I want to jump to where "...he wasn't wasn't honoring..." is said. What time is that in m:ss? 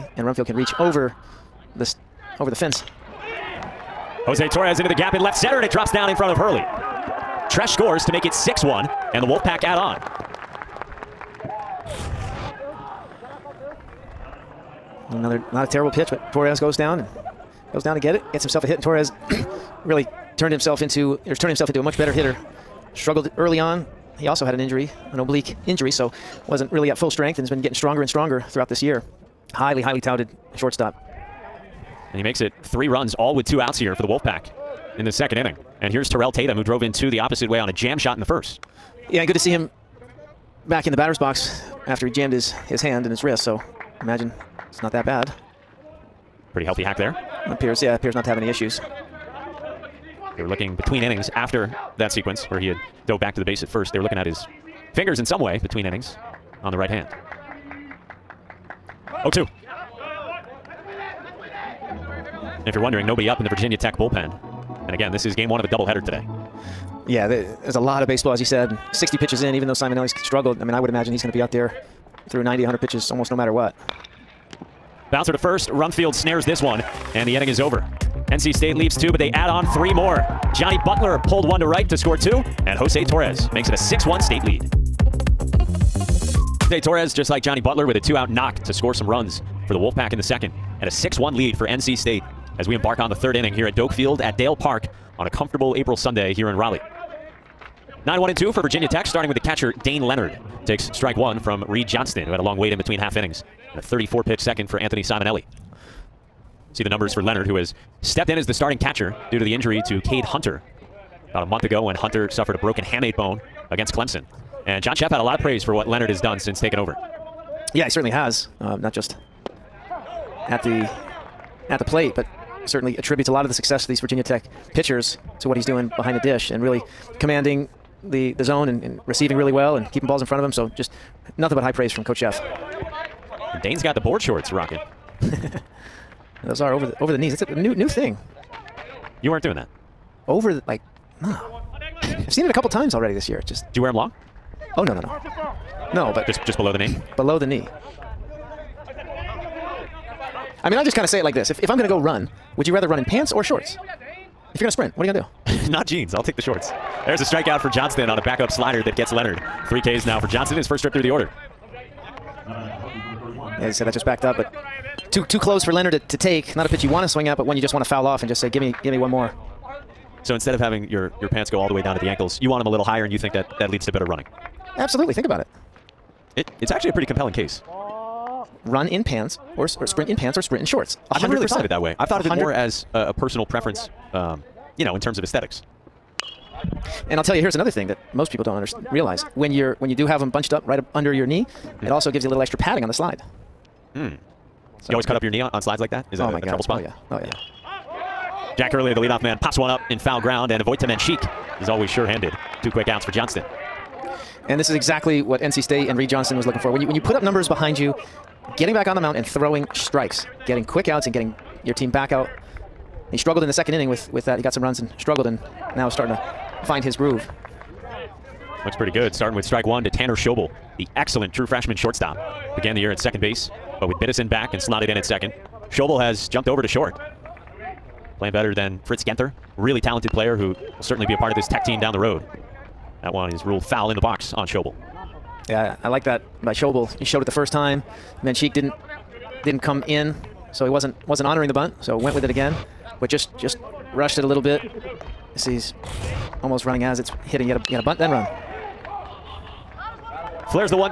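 4:00.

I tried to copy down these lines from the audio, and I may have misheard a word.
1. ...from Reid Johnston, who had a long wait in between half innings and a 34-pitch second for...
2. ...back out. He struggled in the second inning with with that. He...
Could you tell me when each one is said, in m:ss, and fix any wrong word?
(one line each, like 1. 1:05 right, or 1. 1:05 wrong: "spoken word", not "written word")
1. 1:41 right
2. 3:31 right.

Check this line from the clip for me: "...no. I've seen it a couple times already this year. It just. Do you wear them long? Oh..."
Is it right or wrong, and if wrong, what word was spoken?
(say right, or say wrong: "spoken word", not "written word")
right.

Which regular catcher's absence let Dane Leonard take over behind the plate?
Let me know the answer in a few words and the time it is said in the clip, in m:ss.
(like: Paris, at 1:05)
Cade Hunter, at 1:50.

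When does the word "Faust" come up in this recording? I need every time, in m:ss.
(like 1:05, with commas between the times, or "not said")
not said.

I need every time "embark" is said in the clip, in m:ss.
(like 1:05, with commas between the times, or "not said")
1:32.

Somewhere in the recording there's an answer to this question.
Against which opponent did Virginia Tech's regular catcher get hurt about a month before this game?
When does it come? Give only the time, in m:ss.
1:53.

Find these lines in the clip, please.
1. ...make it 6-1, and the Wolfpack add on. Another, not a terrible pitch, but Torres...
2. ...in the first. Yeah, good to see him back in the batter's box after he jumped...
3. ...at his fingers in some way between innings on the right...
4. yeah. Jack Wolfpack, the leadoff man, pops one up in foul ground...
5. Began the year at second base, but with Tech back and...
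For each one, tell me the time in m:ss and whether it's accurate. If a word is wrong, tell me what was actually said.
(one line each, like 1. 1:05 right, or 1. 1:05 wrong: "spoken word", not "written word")
1. 0:08 right
2. 0:38 wrong: "jammed", not "jumped"
3. 0:54 right
4. 3:17 wrong: "Hurley", not "Wolfpack"
5. 3:42 wrong: "Biddison", not "Tech".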